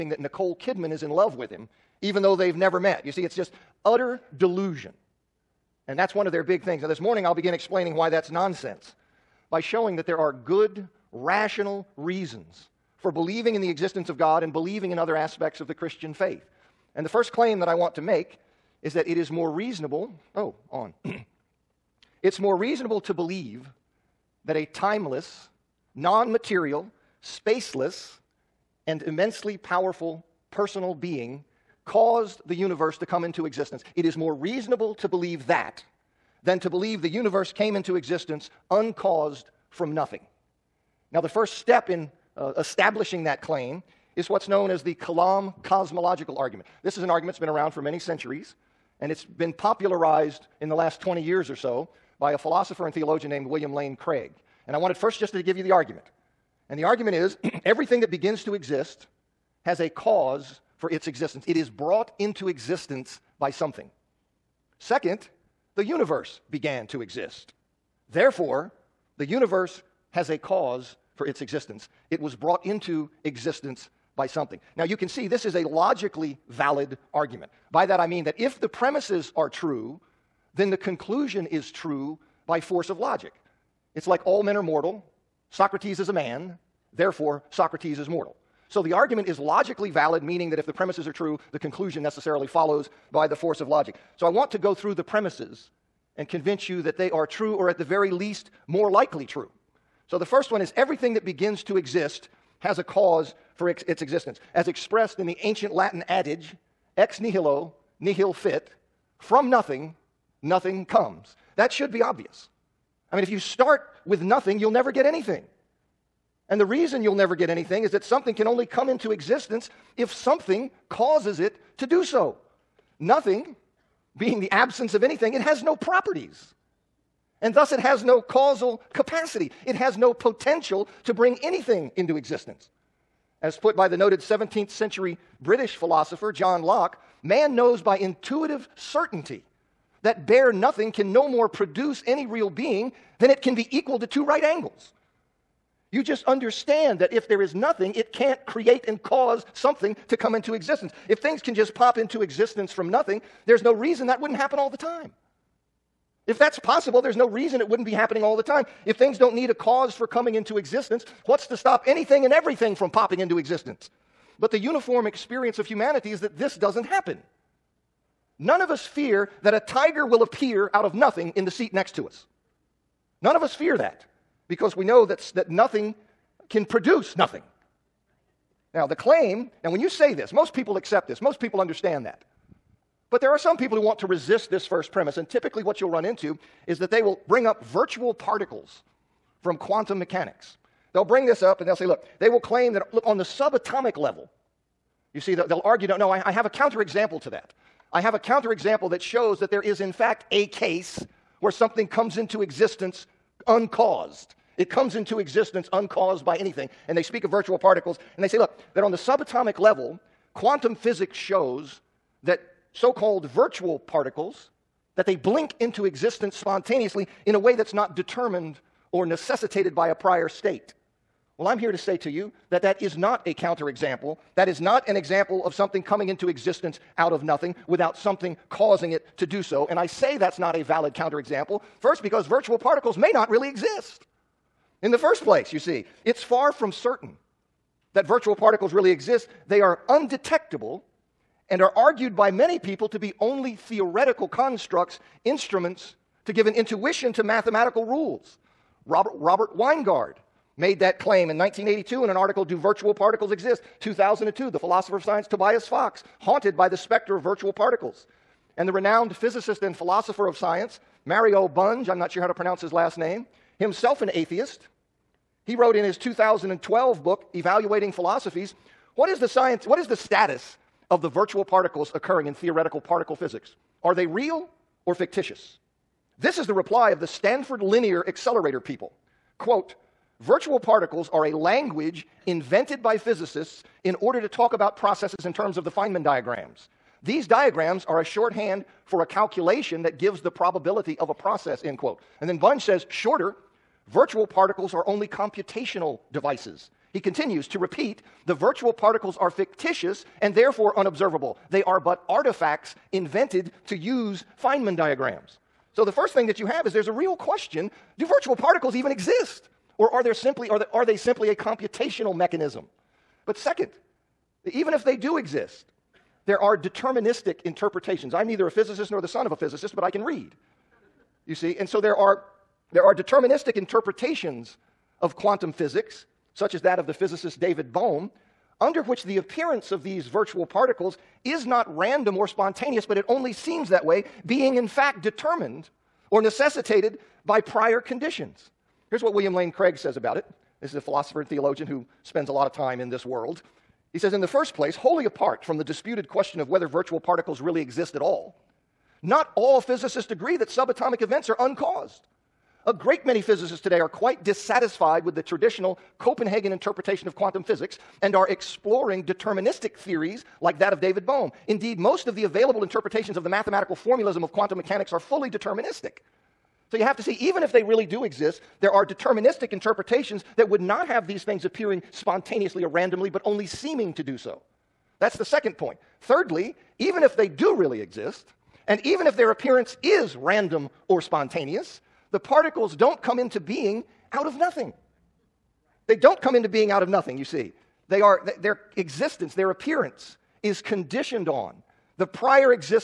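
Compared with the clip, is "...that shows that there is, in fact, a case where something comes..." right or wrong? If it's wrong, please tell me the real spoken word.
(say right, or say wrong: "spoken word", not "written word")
right.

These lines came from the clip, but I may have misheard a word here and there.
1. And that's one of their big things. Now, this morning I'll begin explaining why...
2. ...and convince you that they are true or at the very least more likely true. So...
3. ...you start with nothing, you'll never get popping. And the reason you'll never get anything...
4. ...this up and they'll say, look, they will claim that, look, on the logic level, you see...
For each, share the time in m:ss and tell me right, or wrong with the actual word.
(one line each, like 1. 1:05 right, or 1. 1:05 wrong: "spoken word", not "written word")
1. 0:05 right
2. 1:36 right
3. 1:53 wrong: "anything", not "popping"
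4. 3:11 wrong: "subatomic", not "logic".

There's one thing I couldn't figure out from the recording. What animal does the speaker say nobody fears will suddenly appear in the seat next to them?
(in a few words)
Tiger.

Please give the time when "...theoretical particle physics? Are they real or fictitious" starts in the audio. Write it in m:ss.
4:32.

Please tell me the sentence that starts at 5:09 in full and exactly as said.
Or are, there simply, are, are they simply a computational mechanism?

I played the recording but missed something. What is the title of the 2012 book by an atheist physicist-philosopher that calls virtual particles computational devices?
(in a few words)
Evaluating Philosophies.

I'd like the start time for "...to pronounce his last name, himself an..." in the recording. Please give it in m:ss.
4:22.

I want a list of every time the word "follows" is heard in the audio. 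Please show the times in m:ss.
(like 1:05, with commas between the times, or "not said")
1:32.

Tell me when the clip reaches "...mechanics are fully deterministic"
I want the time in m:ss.
6:04.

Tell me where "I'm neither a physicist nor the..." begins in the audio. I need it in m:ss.
5:18.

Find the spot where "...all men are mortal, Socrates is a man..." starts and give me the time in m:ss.
1:24.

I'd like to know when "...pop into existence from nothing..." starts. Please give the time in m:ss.
2:31.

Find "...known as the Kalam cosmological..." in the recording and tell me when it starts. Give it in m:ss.
0:44.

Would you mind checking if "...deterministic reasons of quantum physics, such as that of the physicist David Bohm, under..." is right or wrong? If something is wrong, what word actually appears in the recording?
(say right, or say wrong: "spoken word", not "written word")
wrong: "interpretations", not "reasons".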